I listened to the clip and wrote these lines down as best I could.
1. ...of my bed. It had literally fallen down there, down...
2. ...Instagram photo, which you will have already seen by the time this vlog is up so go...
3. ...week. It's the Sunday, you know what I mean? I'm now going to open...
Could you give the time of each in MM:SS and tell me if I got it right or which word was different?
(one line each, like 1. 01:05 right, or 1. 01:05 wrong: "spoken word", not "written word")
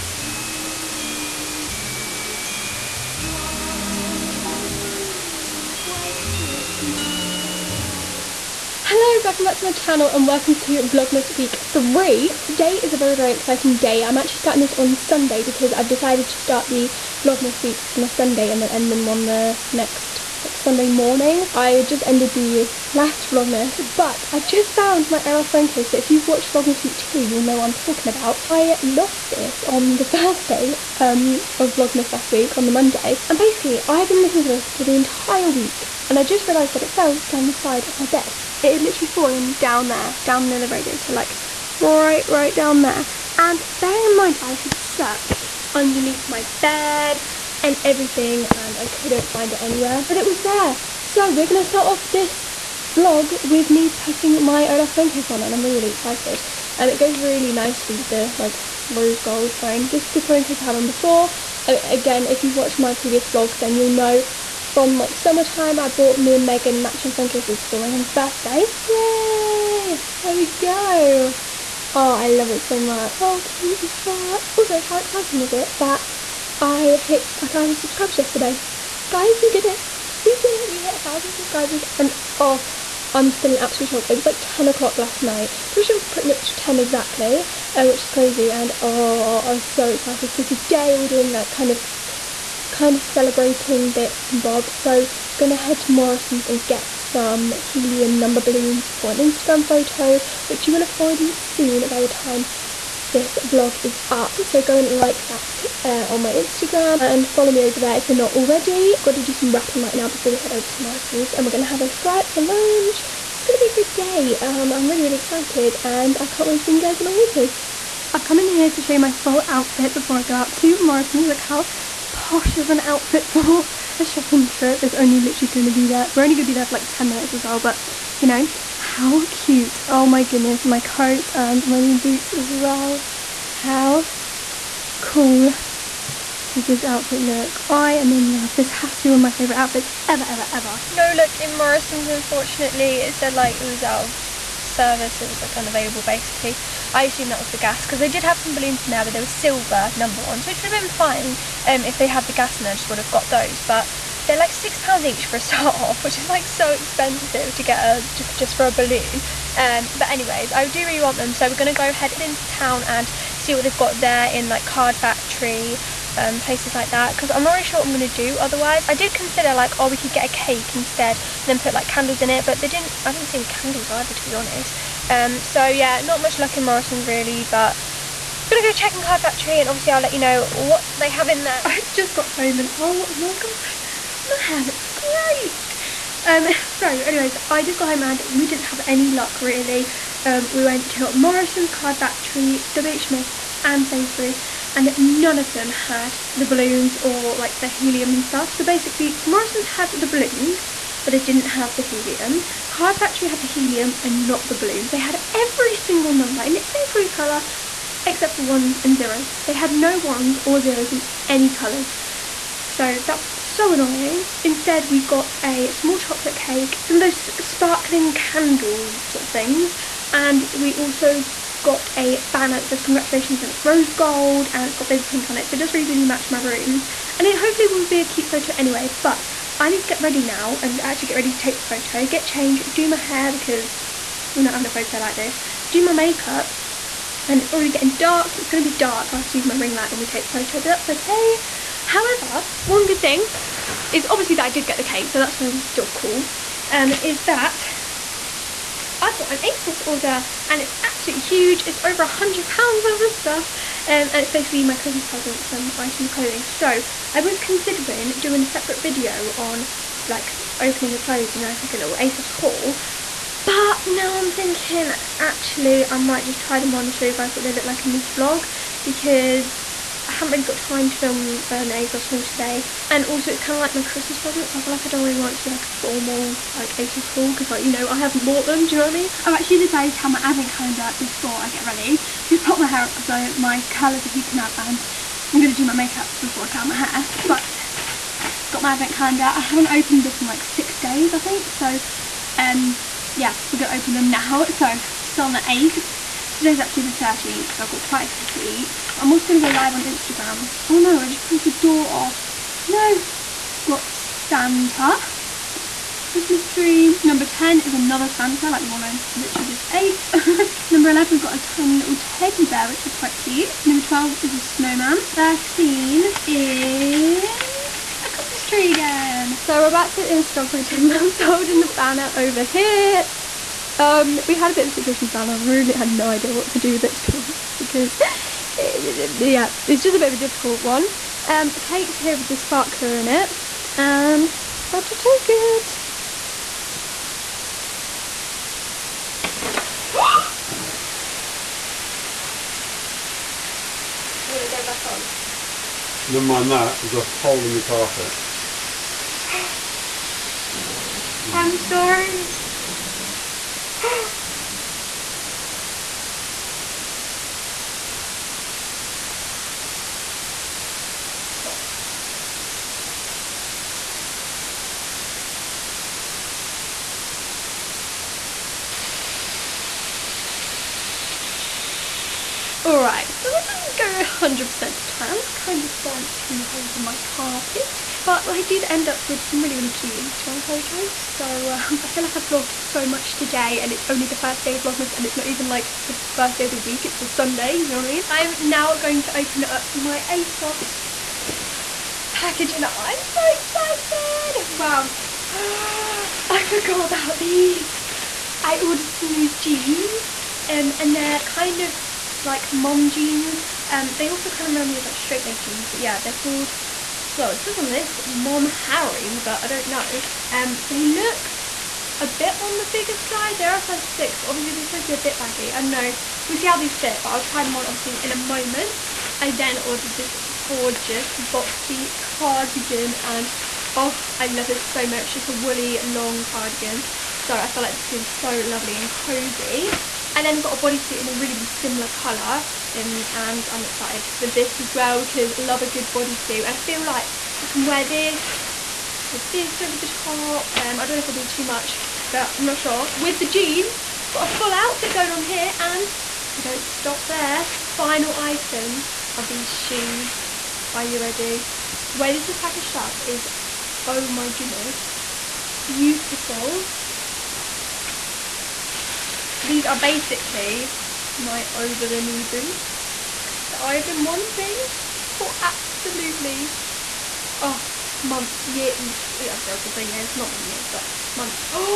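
1. 00:37 right
2. 01:39 right
3. 06:26 right.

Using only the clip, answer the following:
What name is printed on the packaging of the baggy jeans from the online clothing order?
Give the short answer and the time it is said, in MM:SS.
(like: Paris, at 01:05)
Mom Harry, at 06:48.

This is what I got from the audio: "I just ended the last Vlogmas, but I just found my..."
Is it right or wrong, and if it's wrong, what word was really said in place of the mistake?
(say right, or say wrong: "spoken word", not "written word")
right.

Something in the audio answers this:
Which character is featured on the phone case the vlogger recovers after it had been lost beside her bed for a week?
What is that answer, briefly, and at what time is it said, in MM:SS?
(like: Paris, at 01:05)
Olaf, at 00:54.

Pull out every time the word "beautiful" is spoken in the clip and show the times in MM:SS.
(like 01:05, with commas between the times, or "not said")
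07:35.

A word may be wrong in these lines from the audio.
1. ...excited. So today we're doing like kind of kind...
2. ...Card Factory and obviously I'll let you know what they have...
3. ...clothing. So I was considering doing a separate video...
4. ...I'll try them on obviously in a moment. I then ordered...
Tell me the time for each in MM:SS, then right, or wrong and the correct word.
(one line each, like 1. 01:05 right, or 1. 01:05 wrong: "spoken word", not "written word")
1. 01:29 right
2. 02:59 right
3. 04:16 right
4. 06:57 right.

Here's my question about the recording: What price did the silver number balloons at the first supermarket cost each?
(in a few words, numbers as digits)
£6.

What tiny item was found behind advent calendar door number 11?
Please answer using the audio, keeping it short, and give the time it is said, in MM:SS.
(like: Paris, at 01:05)
Teddy bear, at 05:11.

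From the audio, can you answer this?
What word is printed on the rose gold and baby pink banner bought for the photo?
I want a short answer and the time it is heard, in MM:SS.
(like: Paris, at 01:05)
Congratulations, at 03:42.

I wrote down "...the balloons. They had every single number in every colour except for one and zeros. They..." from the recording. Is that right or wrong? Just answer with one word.
right.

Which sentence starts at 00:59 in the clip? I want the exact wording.
This is the phone case I had on before.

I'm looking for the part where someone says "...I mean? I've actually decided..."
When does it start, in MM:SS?
04:38.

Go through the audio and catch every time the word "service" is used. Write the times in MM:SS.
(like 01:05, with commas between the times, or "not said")
02:24.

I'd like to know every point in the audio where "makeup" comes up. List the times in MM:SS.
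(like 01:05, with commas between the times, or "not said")
03:55, 04:45.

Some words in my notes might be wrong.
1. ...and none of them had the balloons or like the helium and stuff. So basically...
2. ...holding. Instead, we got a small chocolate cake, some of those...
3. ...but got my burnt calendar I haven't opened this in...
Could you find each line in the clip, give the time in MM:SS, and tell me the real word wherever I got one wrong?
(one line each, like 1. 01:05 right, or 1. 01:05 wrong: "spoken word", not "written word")
1. 03:14 right
2. 03:33 wrong: "annoying", not "holding"
3. 04:47 wrong: "advent", not "burnt".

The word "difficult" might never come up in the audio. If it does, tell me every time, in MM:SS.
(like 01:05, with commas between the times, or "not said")
05:30.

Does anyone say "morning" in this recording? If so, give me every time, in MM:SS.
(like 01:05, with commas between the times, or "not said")
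00:20.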